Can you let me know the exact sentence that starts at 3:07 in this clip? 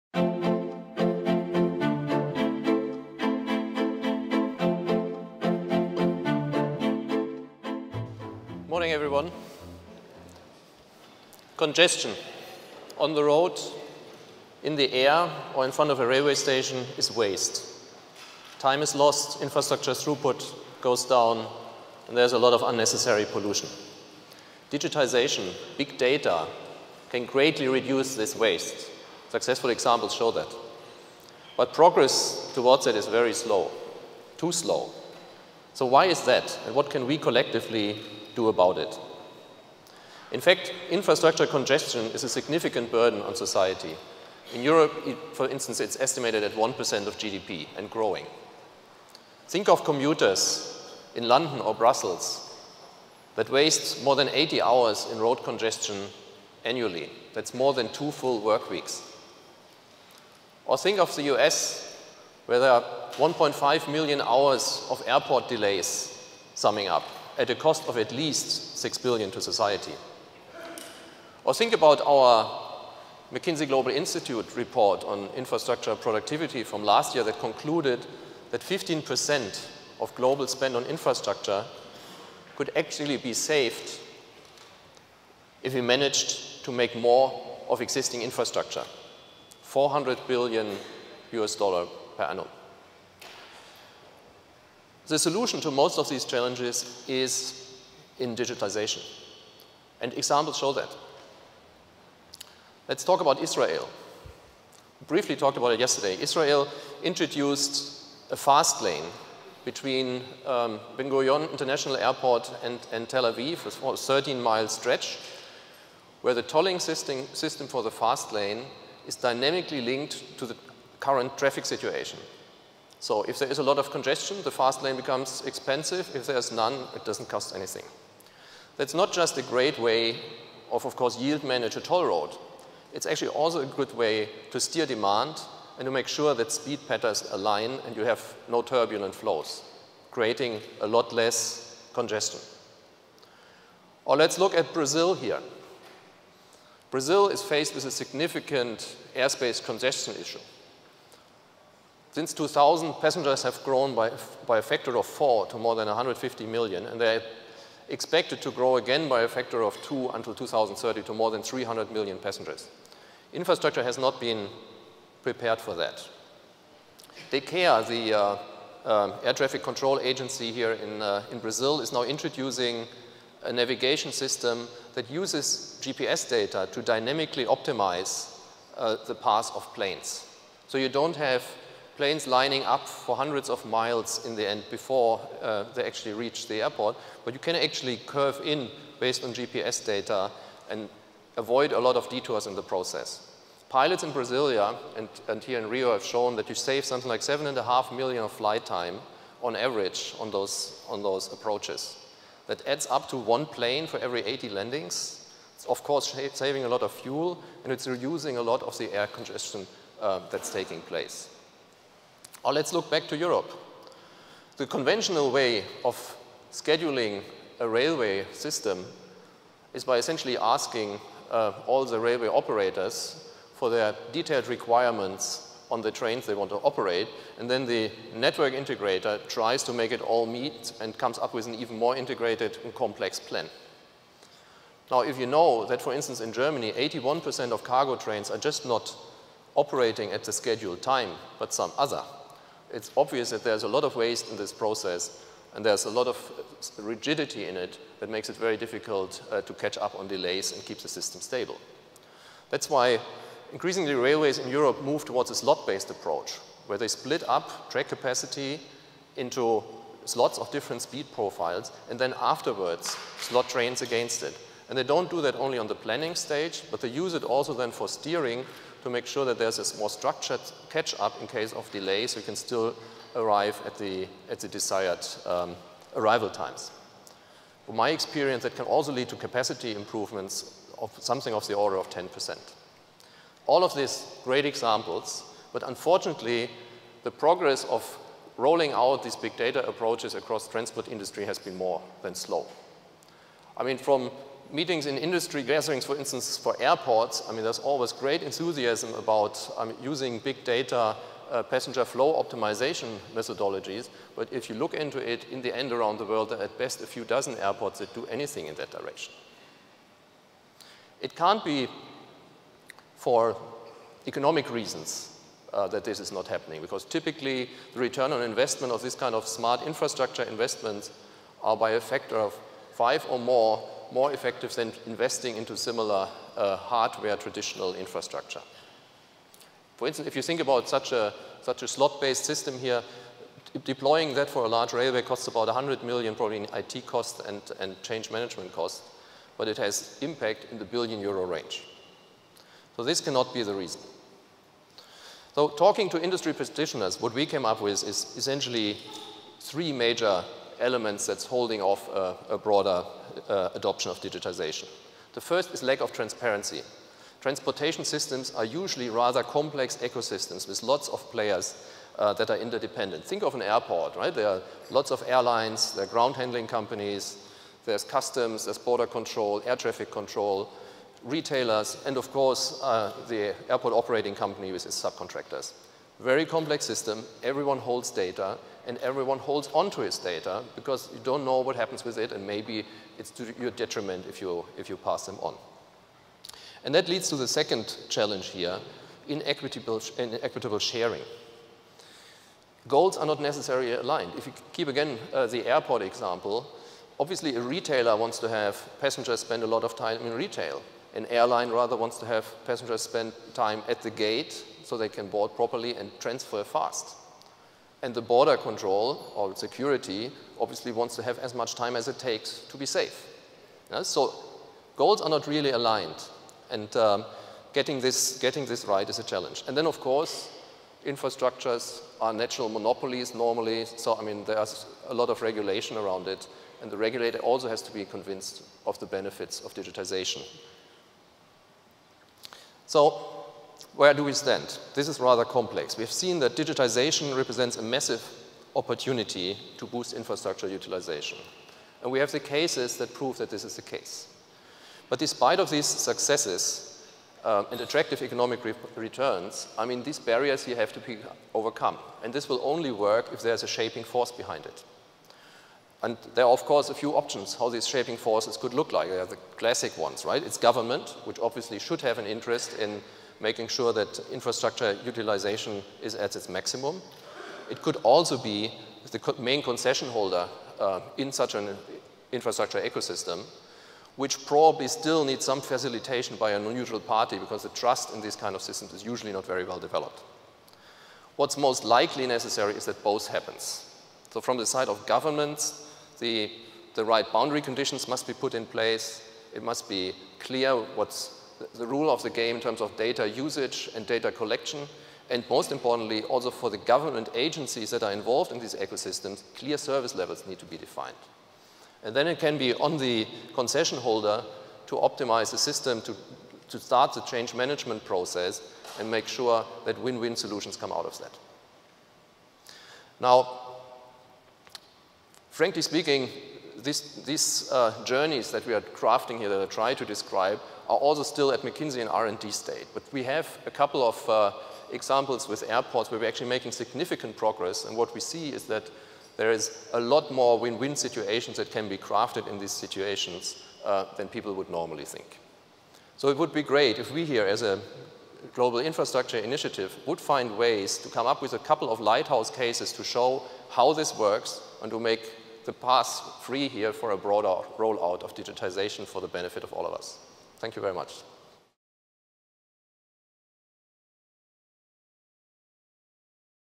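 But you can actually curve in based on GPS data and avoid a lot of detours in the process.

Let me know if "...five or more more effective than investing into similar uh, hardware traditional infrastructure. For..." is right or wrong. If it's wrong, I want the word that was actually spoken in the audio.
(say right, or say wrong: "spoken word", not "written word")
right.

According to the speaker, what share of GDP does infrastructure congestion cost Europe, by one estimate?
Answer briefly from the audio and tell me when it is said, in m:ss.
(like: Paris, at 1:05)
1%, at 0:46.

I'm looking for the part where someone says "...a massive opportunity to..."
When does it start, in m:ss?
7:17.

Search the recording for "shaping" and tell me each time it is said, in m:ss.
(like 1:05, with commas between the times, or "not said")
7:33, 7:37.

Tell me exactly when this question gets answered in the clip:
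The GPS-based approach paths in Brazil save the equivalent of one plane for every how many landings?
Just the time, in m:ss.
3:24.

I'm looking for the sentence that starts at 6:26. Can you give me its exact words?
And that leads to the second challenge here, inequitable, inequitable sharing.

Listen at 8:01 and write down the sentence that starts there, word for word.
What's most likely necessary is that both happens.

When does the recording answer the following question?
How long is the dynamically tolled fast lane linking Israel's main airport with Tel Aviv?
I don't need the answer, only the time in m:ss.
1:53.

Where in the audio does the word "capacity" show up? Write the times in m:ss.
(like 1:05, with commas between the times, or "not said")
4:17, 4:39.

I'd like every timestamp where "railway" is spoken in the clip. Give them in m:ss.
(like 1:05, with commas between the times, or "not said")
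0:16, 3:37, 3:41, 4:13, 5:34.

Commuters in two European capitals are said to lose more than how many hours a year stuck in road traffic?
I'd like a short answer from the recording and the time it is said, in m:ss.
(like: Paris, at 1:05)
80 hours, at 0:54.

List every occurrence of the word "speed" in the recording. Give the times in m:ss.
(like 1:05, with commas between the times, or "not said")
2:16, 4:20.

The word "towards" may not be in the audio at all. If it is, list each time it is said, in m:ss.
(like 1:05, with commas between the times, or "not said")
0:32, 4:15.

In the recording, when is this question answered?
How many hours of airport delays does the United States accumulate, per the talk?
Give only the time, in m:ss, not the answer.
1:03.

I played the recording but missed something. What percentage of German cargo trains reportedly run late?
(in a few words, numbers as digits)
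81%.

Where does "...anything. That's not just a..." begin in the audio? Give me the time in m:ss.
2:07.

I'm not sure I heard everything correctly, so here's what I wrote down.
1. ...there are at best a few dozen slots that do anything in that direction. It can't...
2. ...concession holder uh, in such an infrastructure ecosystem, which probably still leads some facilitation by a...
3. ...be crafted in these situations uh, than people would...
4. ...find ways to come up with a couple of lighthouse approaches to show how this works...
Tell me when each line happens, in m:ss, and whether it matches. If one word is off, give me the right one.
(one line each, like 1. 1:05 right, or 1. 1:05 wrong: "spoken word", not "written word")
1. 5:06 wrong: "airports", not "slots"
2. 7:49 wrong: "needs", not "leads"
3. 8:51 right
4. 8:59 wrong: "cases", not "approaches".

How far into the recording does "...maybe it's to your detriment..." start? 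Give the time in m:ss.
6:22.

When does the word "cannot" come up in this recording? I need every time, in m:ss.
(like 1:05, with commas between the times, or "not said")
5:43.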